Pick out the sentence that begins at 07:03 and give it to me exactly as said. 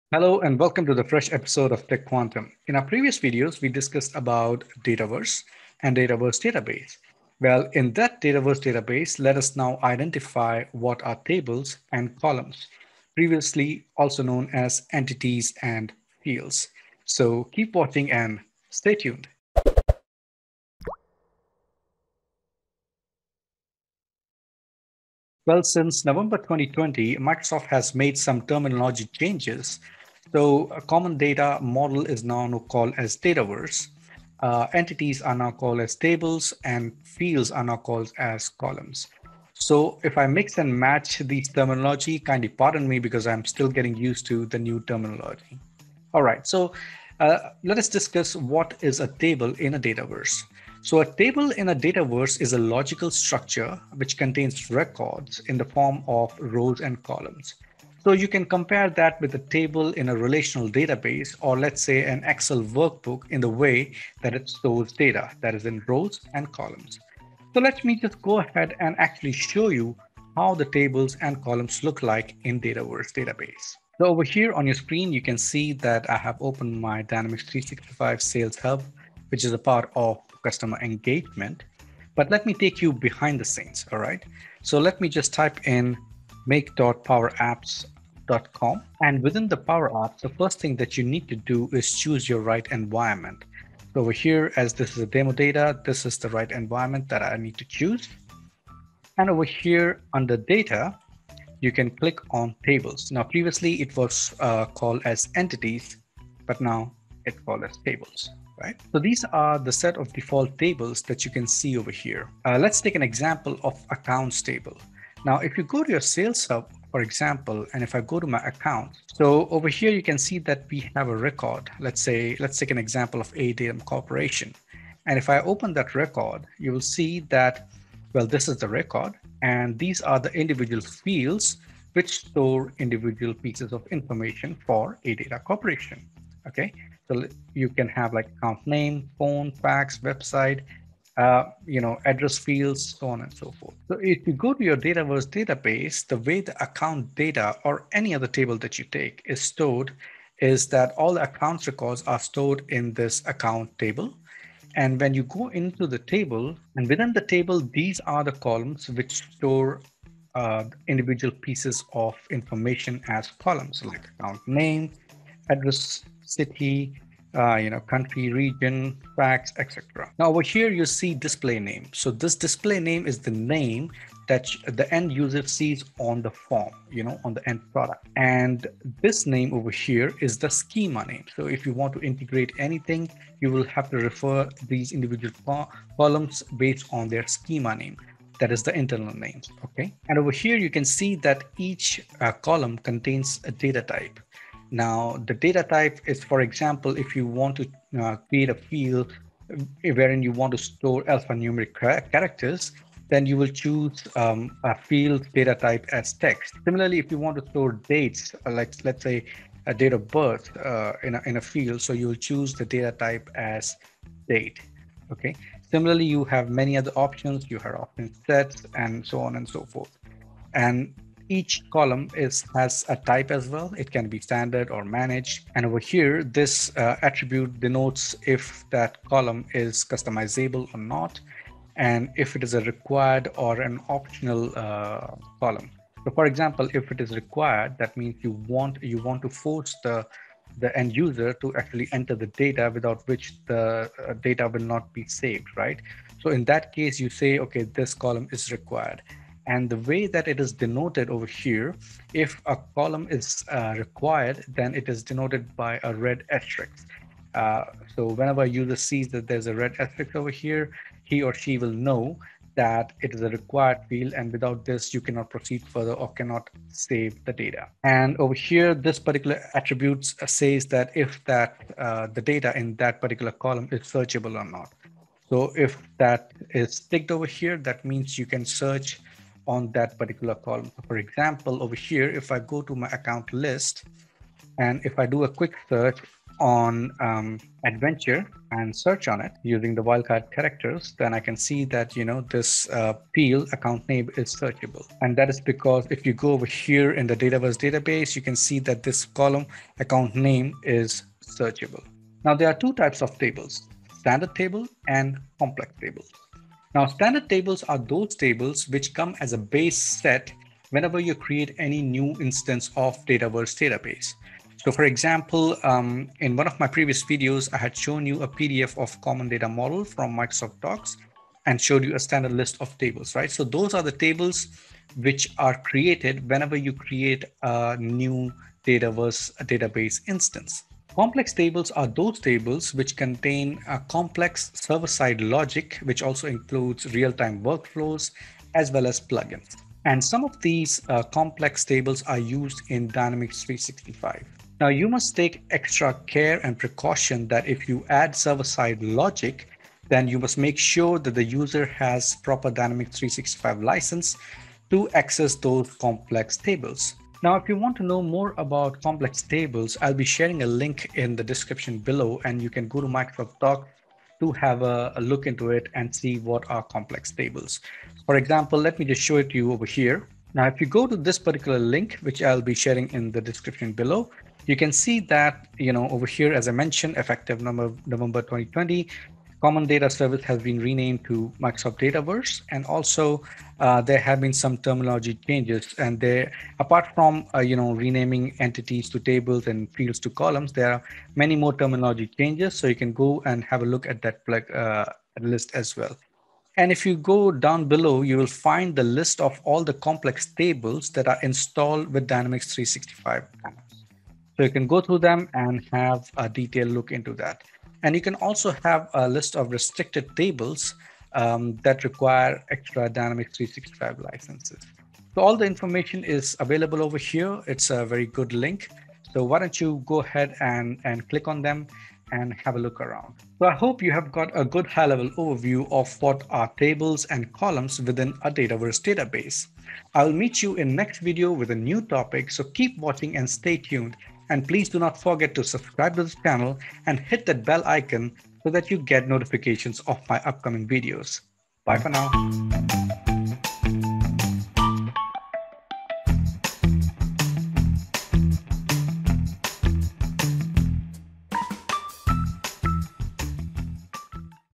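So I hope you have got a good high level overview of what are tables and columns within a Dataverse database.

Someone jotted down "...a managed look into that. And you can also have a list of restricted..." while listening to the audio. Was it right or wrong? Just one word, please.
wrong.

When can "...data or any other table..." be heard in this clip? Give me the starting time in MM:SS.
02:27.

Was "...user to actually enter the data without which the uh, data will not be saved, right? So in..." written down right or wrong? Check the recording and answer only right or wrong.
right.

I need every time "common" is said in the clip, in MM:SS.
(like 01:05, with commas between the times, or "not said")
00:30, 05:19, 06:19.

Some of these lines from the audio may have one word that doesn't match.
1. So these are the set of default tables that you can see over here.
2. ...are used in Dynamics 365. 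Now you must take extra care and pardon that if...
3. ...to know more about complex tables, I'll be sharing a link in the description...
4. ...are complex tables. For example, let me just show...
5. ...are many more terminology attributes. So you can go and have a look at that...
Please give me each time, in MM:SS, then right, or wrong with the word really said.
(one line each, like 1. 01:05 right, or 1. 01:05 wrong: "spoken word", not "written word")
1. 01:48 right
2. 05:42 wrong: "precaution", not "pardon"
3. 05:57 right
4. 06:06 right
5. 06:30 wrong: "changes", not "attributes".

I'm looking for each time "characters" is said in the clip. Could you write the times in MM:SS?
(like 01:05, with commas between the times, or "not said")
03:22, 04:50.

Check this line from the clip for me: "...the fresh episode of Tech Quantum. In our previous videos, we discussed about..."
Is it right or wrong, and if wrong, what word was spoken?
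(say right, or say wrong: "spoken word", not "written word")
right.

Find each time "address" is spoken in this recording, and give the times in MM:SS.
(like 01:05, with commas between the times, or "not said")
02:22, 02:45.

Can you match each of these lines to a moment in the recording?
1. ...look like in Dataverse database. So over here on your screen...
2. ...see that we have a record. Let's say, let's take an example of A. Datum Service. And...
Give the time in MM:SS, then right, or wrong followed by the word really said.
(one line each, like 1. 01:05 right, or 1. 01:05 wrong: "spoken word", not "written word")
1. 01:11 right
2. 02:00 wrong: "Corporation", not "Service".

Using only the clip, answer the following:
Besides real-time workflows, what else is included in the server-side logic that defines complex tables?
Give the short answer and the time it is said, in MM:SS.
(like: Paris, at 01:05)
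Plugins, at 05:38.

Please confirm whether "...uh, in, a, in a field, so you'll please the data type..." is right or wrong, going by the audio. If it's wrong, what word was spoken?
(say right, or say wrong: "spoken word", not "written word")
wrong: "choose", not "please".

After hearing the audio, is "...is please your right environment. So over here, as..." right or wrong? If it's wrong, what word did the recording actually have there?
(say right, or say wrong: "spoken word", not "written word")
wrong: "choose", not "please".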